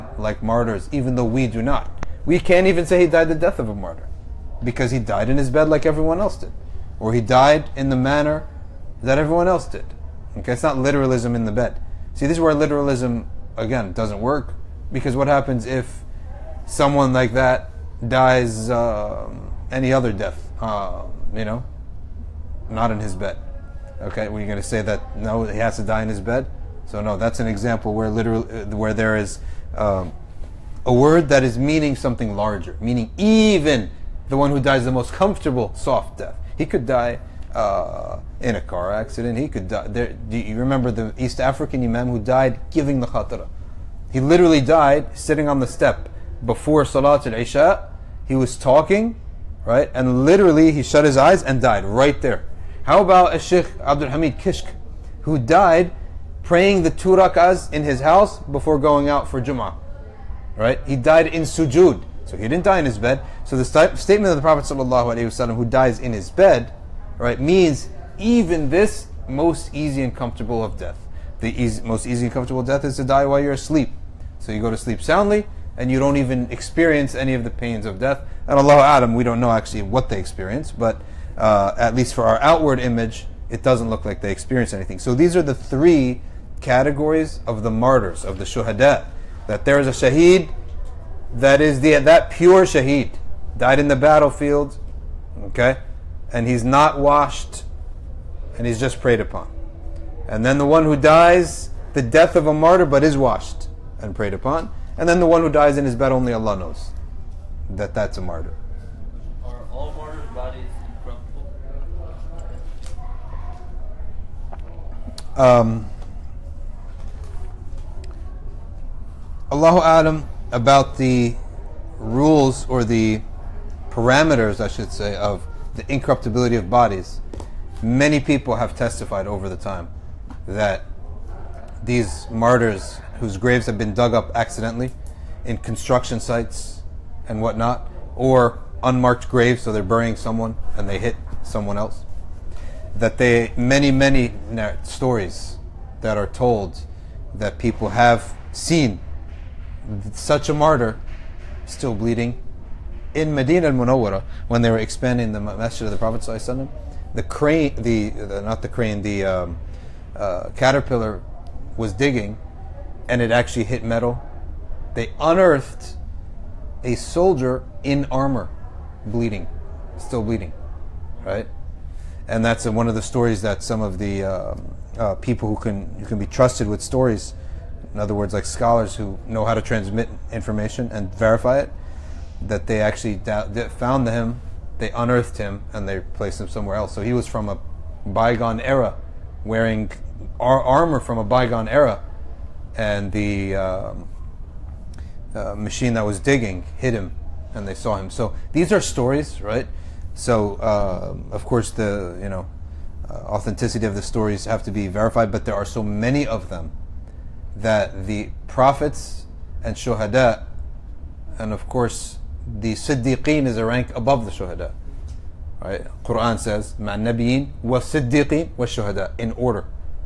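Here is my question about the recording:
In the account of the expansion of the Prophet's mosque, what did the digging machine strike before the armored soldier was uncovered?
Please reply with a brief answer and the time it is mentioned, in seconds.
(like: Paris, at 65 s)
Metal, at 163 s.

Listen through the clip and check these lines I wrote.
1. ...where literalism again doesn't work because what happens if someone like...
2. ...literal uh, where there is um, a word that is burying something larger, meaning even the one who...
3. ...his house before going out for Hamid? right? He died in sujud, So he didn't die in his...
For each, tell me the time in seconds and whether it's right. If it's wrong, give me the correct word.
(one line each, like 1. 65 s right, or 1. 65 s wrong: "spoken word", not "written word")
1. 12 s right
2. 28 s wrong: "meaning", not "burying"
3. 57 s wrong: "Jummah", not "Hamid".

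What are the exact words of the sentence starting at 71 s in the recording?
The easy, most easy and comfortable death is to die while you're asleep.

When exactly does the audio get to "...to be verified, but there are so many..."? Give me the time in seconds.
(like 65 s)
204 s.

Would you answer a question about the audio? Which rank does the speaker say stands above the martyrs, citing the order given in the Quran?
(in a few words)
Siddiqeen.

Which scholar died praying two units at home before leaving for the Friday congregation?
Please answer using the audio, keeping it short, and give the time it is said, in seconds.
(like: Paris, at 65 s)
Sheikh Abdul Hamid Kishk, at 53 s.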